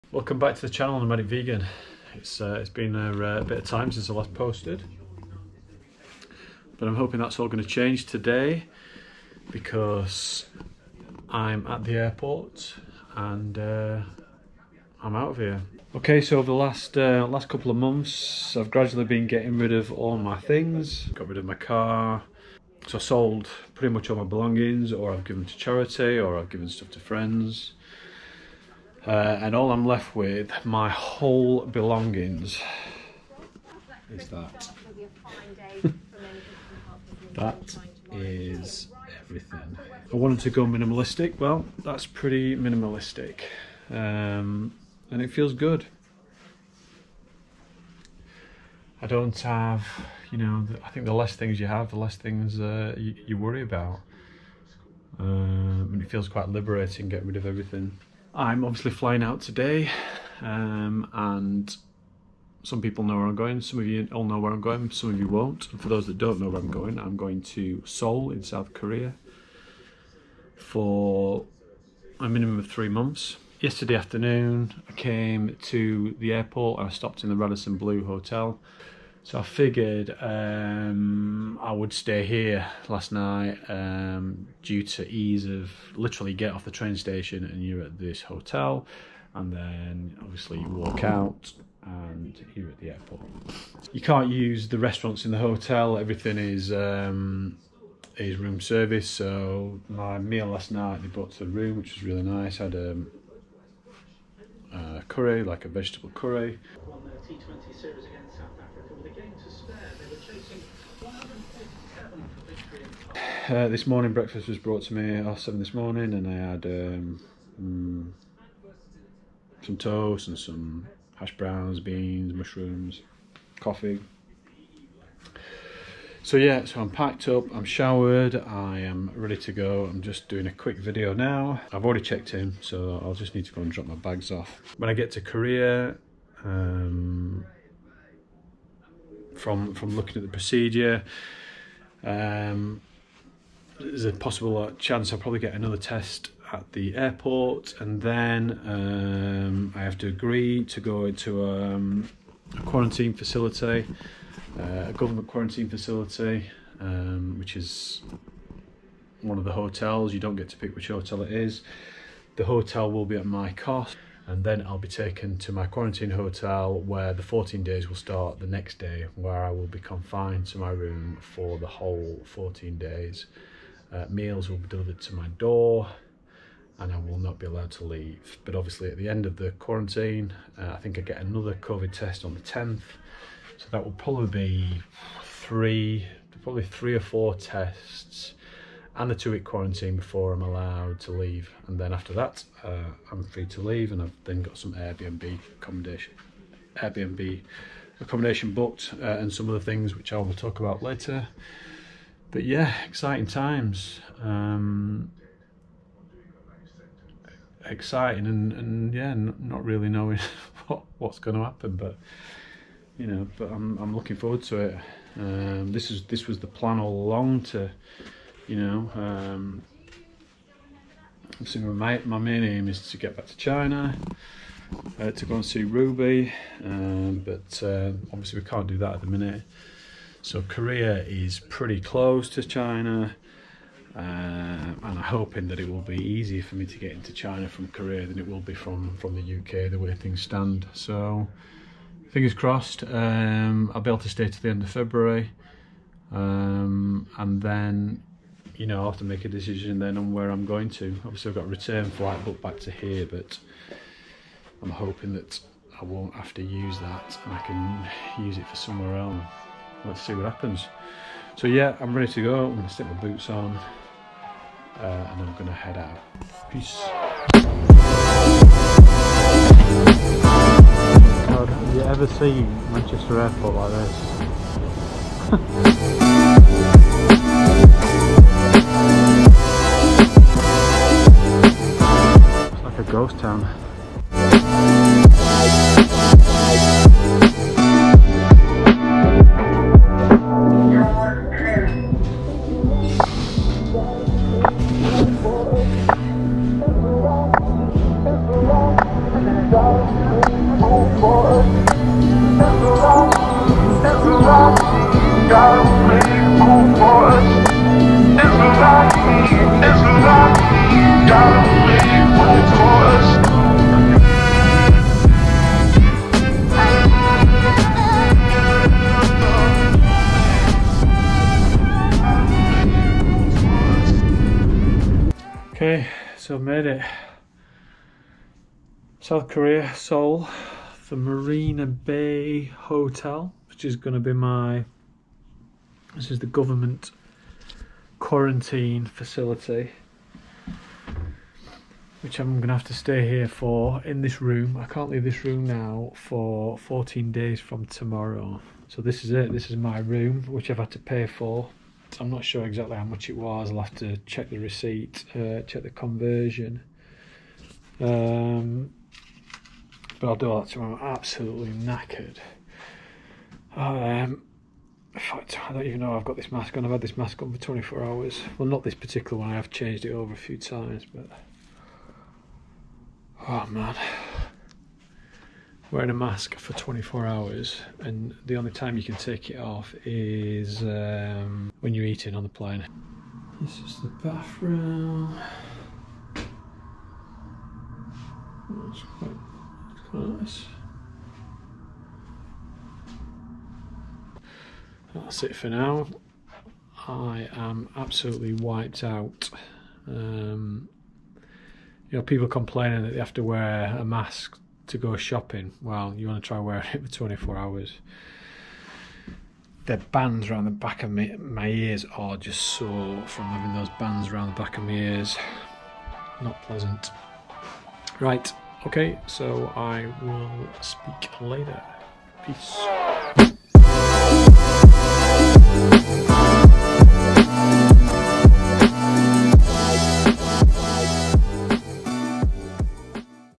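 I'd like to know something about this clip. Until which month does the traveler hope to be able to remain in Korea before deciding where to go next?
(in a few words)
February.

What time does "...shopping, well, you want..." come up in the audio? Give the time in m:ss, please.
6:44.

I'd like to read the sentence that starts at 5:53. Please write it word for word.
I'll have to check the receipt, uh, check the conversion.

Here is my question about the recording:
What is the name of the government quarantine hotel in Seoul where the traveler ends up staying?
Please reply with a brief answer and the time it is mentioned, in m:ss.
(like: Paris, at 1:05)
Marina Bay Hotel, at 5:30.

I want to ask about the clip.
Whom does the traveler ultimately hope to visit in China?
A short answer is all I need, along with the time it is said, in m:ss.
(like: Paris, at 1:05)
Ruby, at 3:45.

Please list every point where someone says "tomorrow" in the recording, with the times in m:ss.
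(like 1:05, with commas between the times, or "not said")
5:47, 6:00.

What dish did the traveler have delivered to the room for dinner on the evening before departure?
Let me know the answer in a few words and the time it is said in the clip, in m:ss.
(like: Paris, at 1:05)
vegetable curry, at 1:45.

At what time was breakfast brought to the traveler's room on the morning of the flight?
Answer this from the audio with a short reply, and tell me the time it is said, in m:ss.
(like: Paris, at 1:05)
7, at 1:55.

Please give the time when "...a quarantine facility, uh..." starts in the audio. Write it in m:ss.
2:32.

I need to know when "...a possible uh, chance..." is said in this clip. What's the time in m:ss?
2:24.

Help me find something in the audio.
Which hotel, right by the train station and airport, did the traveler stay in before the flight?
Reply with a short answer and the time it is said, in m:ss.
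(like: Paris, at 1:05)
Radisson Blu Hotel, at 1:17.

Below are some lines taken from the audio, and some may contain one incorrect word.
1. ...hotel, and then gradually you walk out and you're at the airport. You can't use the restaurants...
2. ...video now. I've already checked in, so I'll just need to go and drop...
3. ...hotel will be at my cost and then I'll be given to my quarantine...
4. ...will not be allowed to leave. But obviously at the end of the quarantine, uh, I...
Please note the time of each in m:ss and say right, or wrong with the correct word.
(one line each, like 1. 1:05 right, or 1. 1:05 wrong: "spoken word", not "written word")
1. 1:28 wrong: "obviously", not "gradually"
2. 2:10 right
3. 2:42 wrong: "taken", not "given"
4. 2:56 right.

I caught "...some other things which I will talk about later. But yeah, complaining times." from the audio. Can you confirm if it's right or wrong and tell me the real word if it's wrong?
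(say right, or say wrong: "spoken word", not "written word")
wrong: "exciting", not "complaining".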